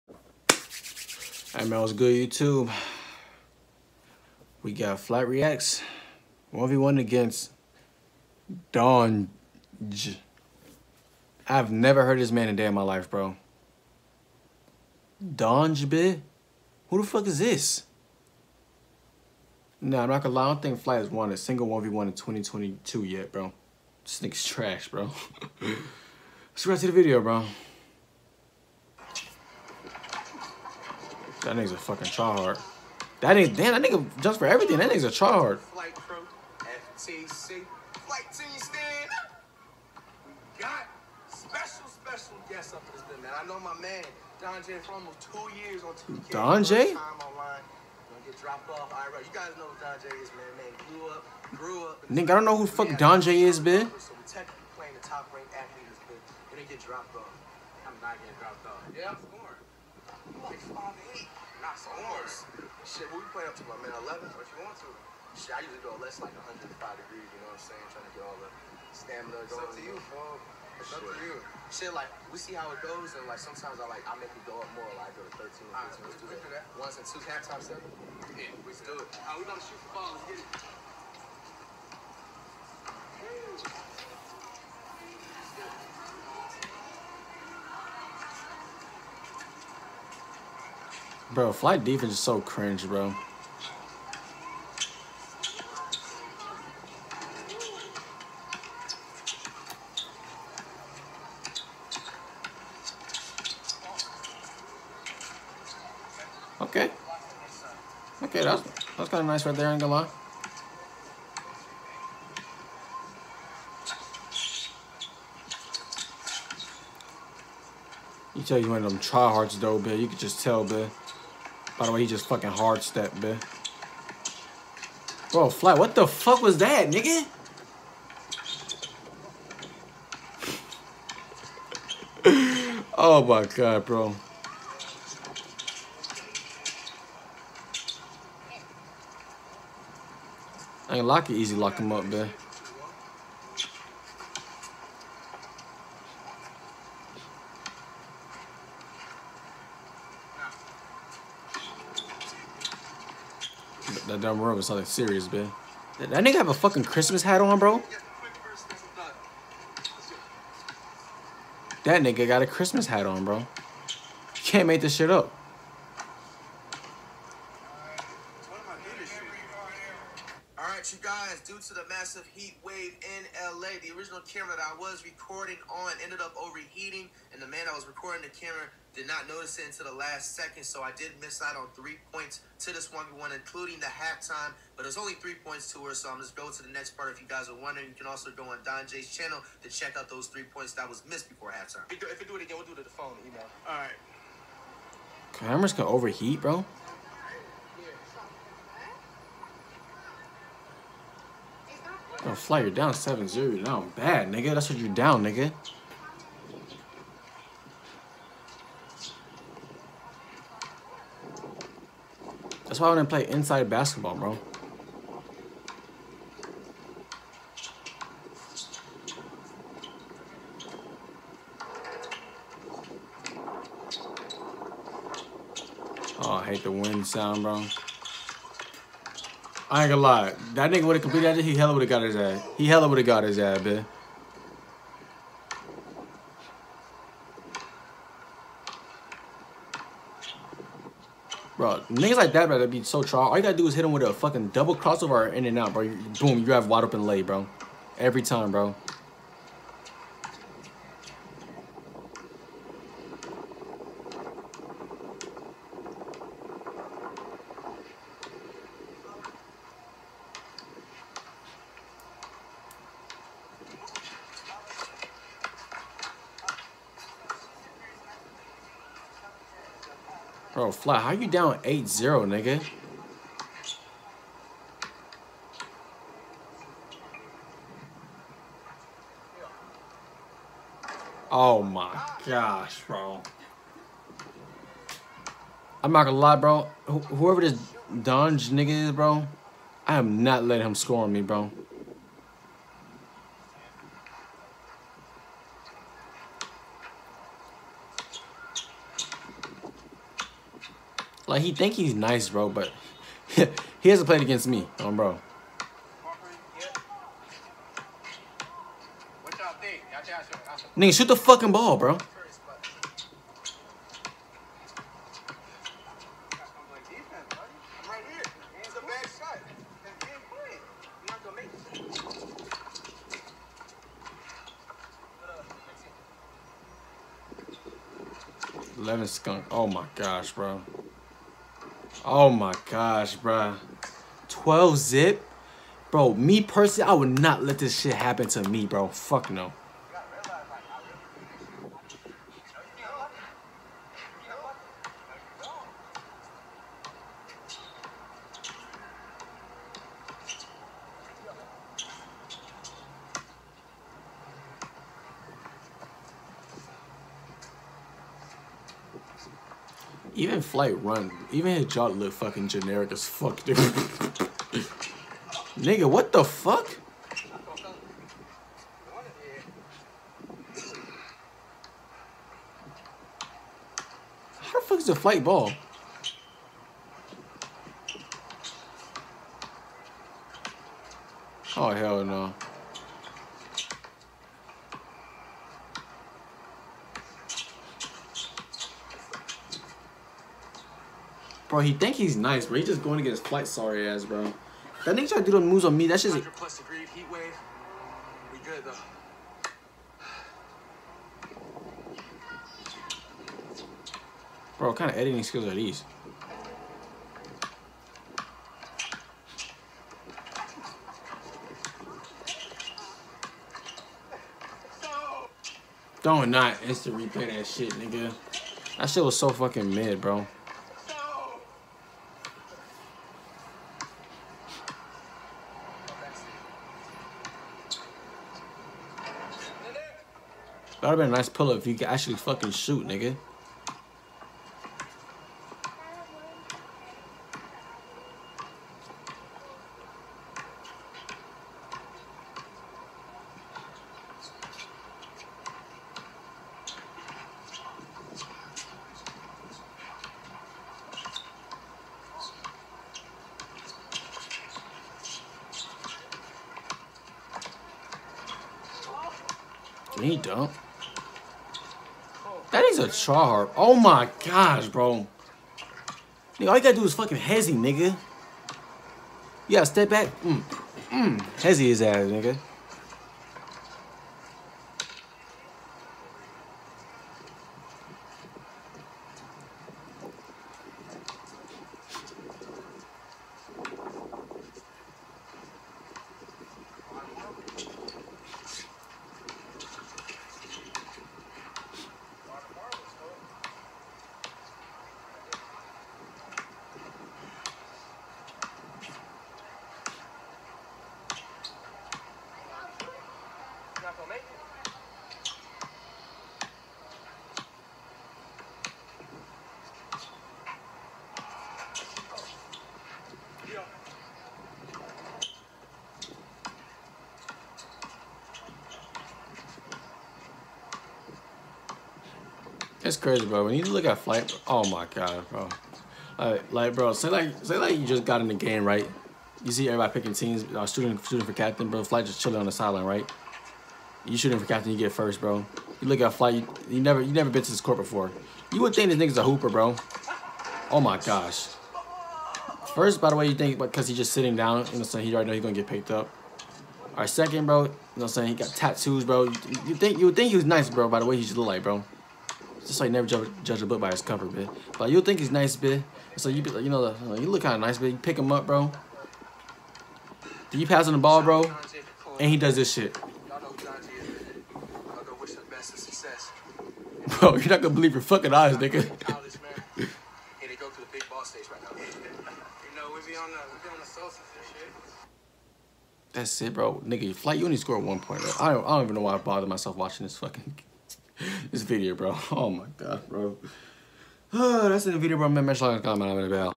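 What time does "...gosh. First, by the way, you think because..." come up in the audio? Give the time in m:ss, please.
9:00.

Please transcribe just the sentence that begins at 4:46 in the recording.
Wh whoever this Don J nigga is, bro, I am not letting him score on me, bro.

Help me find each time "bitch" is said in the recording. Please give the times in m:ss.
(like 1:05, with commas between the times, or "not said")
0:53, 2:03.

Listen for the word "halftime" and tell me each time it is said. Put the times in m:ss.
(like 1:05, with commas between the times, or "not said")
1:17, 3:03, 3:11.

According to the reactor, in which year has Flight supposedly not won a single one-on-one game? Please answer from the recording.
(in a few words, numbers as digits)
2022.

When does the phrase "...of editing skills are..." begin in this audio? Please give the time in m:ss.
6:44.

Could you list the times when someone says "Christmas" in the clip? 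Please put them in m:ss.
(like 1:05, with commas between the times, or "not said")
2:36, 2:42.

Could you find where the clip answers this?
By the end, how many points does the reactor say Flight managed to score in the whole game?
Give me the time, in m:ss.
9:37.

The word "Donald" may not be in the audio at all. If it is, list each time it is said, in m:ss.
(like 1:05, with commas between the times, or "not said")
not said.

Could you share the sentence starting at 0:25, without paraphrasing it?
Let's go right to the video, bro.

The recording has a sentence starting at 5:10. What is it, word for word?
Nigga, shoot the fucking ball, bro.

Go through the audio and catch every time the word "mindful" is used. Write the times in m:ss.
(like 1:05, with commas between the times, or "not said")
not said.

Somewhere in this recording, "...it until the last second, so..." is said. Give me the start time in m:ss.
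2:59.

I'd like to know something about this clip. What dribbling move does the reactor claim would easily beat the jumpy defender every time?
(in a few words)
double crossover.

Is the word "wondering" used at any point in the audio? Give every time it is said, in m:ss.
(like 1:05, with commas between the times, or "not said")
3:07.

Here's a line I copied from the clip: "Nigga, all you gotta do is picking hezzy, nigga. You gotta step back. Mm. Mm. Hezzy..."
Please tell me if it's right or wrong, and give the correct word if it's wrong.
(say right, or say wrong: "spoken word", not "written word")
wrong: "fucking", not "picking".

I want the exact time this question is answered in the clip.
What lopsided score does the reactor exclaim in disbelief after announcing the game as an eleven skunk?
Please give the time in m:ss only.
5:34.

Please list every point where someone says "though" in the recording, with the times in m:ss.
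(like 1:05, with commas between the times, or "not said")
1:59, 6:38.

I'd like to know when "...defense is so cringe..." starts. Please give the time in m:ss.
1:31.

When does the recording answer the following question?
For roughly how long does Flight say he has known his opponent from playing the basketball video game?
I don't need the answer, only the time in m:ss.
0:44.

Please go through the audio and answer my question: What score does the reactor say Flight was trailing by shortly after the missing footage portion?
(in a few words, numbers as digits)
7-0.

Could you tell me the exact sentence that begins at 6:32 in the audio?
He just going to get his flight sorry ass, bro.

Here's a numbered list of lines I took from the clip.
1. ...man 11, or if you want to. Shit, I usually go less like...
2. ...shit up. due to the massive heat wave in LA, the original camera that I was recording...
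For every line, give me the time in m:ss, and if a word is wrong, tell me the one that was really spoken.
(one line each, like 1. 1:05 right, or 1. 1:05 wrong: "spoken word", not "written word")
1. 1:03 right
2. 2:44 right.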